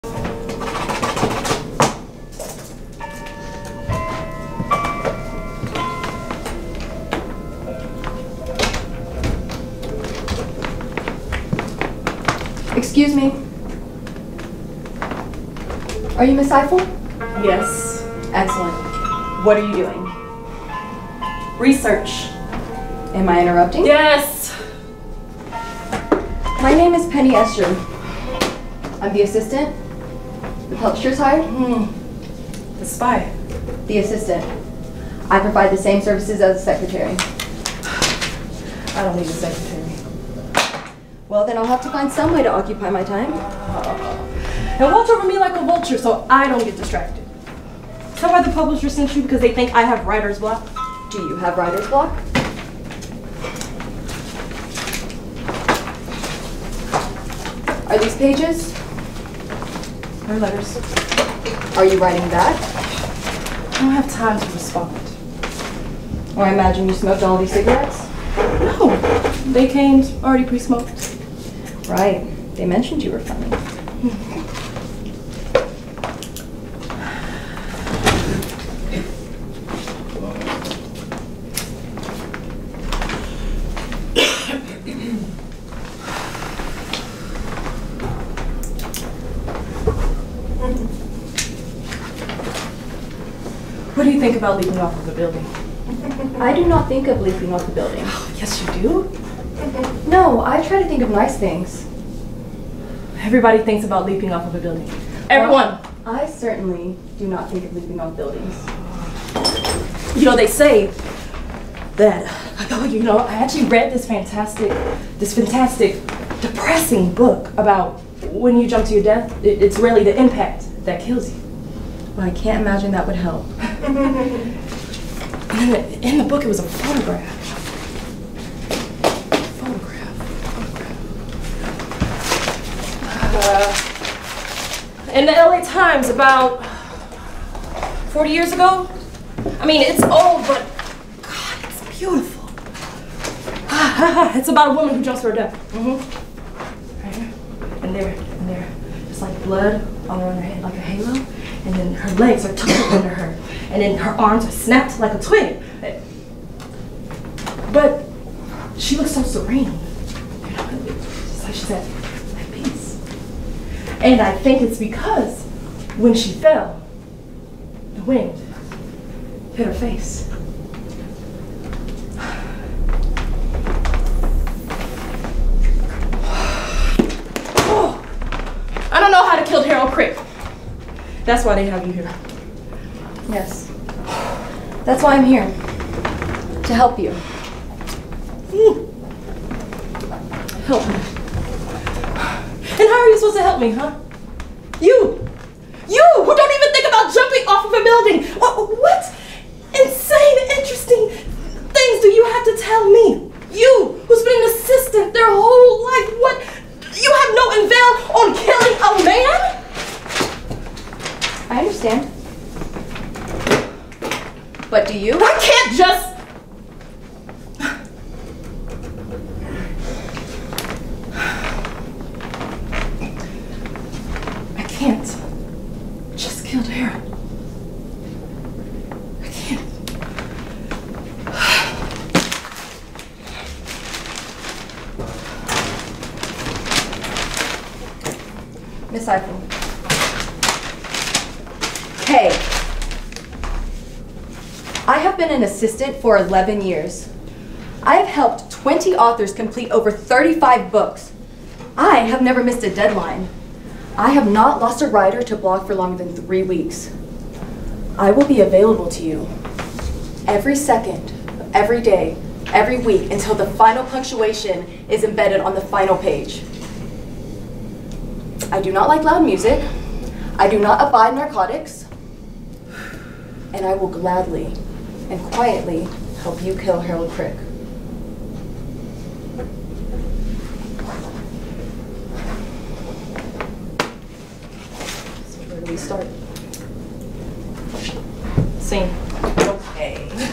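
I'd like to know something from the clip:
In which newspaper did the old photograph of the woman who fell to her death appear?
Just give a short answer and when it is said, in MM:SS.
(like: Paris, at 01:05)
LA Times, at 02:15.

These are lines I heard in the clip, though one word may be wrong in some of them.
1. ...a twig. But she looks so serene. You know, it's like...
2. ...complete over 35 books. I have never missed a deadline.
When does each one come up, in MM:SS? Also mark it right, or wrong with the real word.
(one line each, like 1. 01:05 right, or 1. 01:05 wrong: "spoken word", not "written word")
1. 02:35 right
2. 04:09 right.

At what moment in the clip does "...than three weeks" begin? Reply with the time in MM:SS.
04:16.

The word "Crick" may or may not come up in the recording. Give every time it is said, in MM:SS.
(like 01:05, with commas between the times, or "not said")
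02:59, 04:37.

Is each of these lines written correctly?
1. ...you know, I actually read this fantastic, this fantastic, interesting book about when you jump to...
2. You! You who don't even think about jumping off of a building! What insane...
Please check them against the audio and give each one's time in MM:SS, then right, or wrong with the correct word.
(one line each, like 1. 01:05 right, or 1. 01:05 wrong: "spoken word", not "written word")
1. 01:52 wrong: "depressing", not "interesting"
2. 03:14 right.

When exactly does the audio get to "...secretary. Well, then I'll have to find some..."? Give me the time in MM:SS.
00:39.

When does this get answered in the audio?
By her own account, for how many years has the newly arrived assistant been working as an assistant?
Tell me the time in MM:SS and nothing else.
04:06.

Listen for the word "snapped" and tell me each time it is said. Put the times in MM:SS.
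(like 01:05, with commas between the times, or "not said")
02:34.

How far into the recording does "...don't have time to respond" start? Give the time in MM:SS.
01:03.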